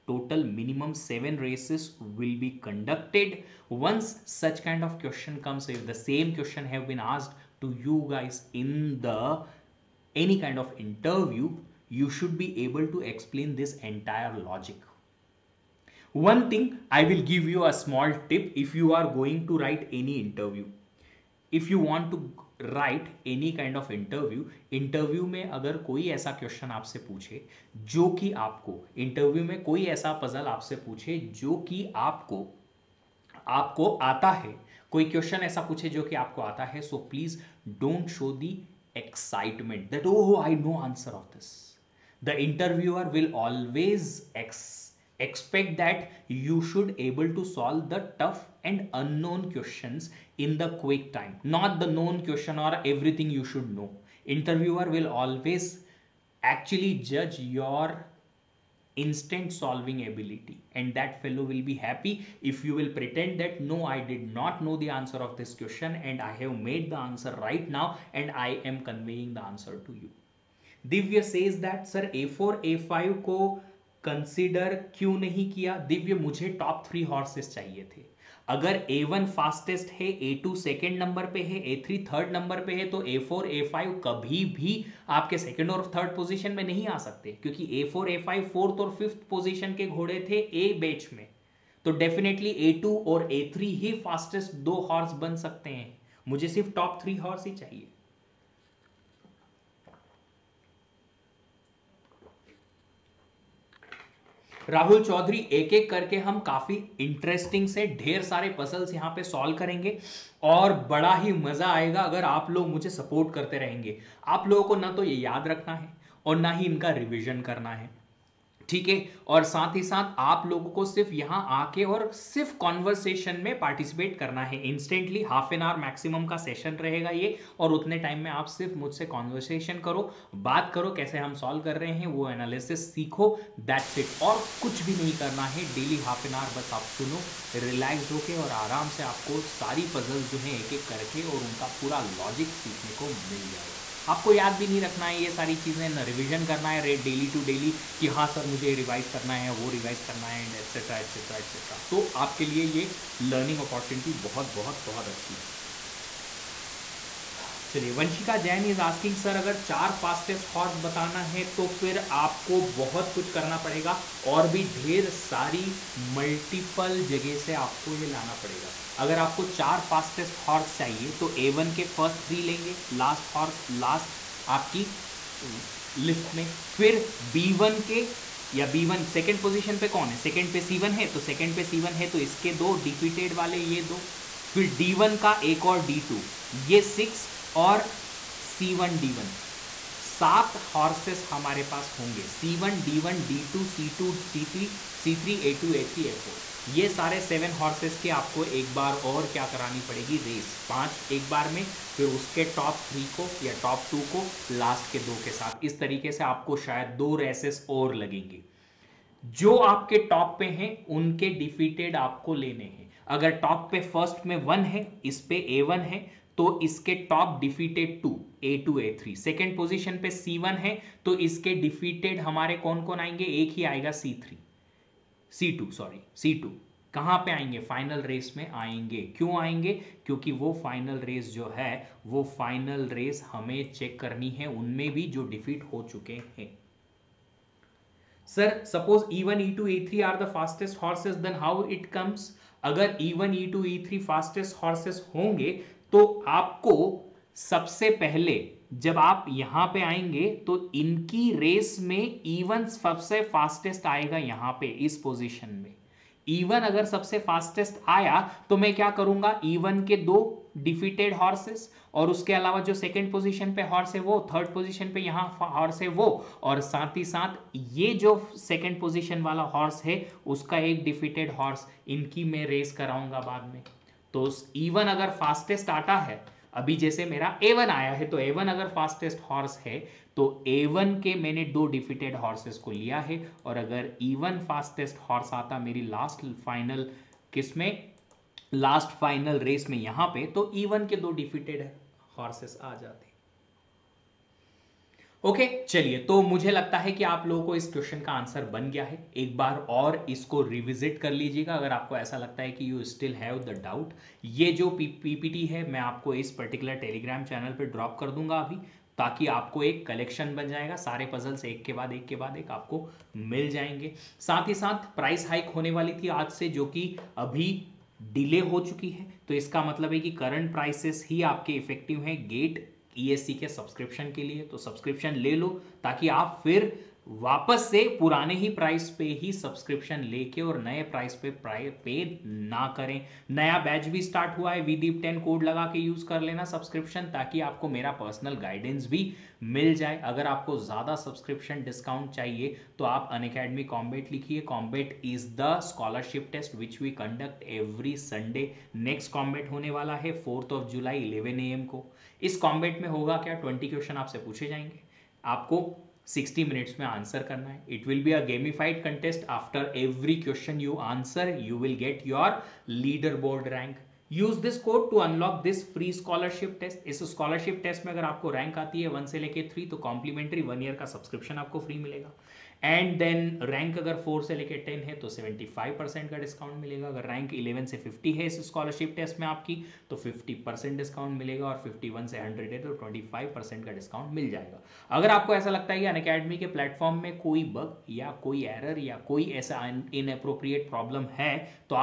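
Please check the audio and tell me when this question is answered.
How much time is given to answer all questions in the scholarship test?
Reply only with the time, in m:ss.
5:56.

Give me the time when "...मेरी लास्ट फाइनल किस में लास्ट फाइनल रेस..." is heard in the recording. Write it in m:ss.
4:45.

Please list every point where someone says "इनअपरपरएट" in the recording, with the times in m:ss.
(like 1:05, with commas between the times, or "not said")
6:30.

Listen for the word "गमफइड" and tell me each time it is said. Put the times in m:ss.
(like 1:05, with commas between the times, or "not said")
5:58.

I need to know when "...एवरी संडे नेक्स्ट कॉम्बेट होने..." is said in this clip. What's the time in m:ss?
5:47.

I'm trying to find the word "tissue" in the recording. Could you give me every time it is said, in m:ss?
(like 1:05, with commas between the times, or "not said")
not said.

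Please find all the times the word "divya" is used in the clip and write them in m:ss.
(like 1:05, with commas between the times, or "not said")
1:10, 1:15.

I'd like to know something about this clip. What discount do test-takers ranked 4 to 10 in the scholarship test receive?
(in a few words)
75%.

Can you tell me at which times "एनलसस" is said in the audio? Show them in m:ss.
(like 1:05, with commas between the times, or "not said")
2:12.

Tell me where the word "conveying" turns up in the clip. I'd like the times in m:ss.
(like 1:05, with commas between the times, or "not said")
1:08.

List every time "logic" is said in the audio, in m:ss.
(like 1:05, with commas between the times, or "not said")
0:14.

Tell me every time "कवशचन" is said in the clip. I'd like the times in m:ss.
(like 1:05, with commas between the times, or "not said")
0:26, 0:35, 4:57, 5:53, 6:00.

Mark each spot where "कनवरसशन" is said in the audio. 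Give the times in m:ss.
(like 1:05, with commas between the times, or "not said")
2:02, 2:09.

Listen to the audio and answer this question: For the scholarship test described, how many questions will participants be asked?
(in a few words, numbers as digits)
20.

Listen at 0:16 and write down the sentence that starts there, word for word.
One thing I will give you a small tip if you are going to write any interview.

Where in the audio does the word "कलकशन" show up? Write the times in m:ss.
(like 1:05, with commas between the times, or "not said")
5:09.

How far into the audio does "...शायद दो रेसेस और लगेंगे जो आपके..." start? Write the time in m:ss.
3:26.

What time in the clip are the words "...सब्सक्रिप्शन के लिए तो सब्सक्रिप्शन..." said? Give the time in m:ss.
5:23.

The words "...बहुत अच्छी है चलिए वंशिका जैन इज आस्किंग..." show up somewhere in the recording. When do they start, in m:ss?
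2:34.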